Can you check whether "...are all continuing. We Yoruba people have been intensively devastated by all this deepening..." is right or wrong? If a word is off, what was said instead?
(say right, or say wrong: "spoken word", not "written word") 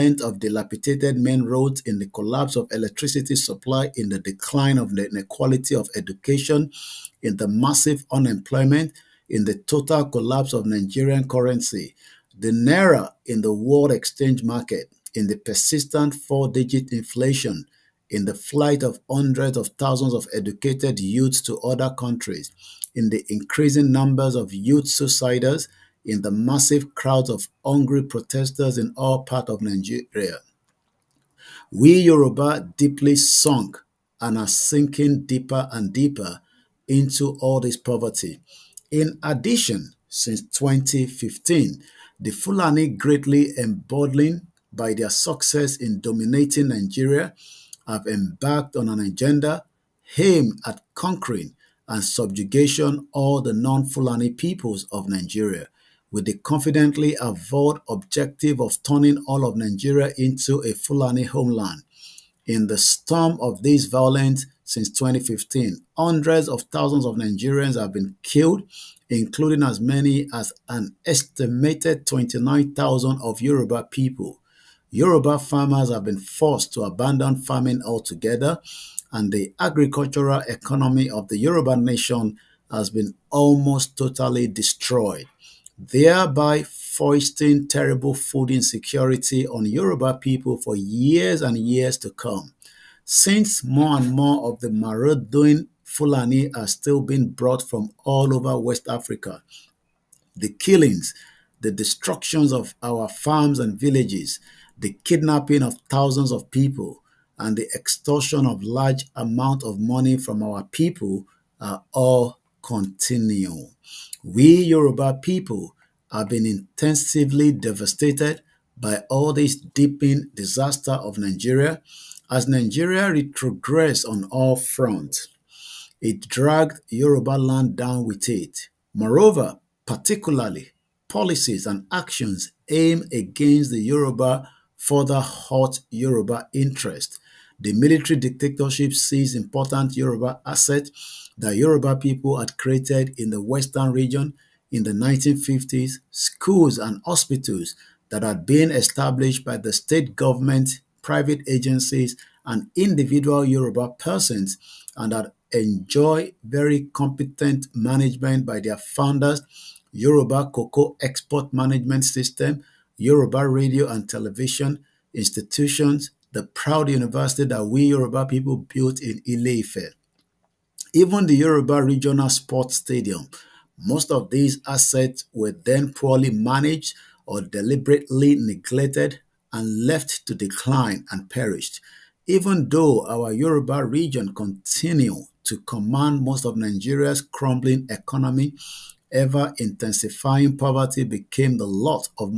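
right.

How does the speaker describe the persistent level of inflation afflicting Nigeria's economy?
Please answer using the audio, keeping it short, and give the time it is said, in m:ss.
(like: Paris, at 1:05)
four digit, at 0:16.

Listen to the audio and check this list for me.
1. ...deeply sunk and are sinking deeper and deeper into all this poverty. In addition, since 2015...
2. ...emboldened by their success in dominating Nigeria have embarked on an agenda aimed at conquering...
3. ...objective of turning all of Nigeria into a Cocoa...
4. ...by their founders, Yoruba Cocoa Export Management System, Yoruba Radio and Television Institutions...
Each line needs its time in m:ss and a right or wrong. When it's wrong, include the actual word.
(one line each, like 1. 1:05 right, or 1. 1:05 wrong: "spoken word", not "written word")
1. 0:32 right
2. 0:43 right
3. 0:57 wrong: "Fulani", not "Cocoa"
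4. 2:38 right.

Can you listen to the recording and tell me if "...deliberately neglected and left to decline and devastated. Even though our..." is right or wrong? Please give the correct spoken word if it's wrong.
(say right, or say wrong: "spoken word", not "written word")
wrong: "perished", not "devastated".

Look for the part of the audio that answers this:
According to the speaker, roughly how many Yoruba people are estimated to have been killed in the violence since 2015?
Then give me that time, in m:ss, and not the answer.
1:12.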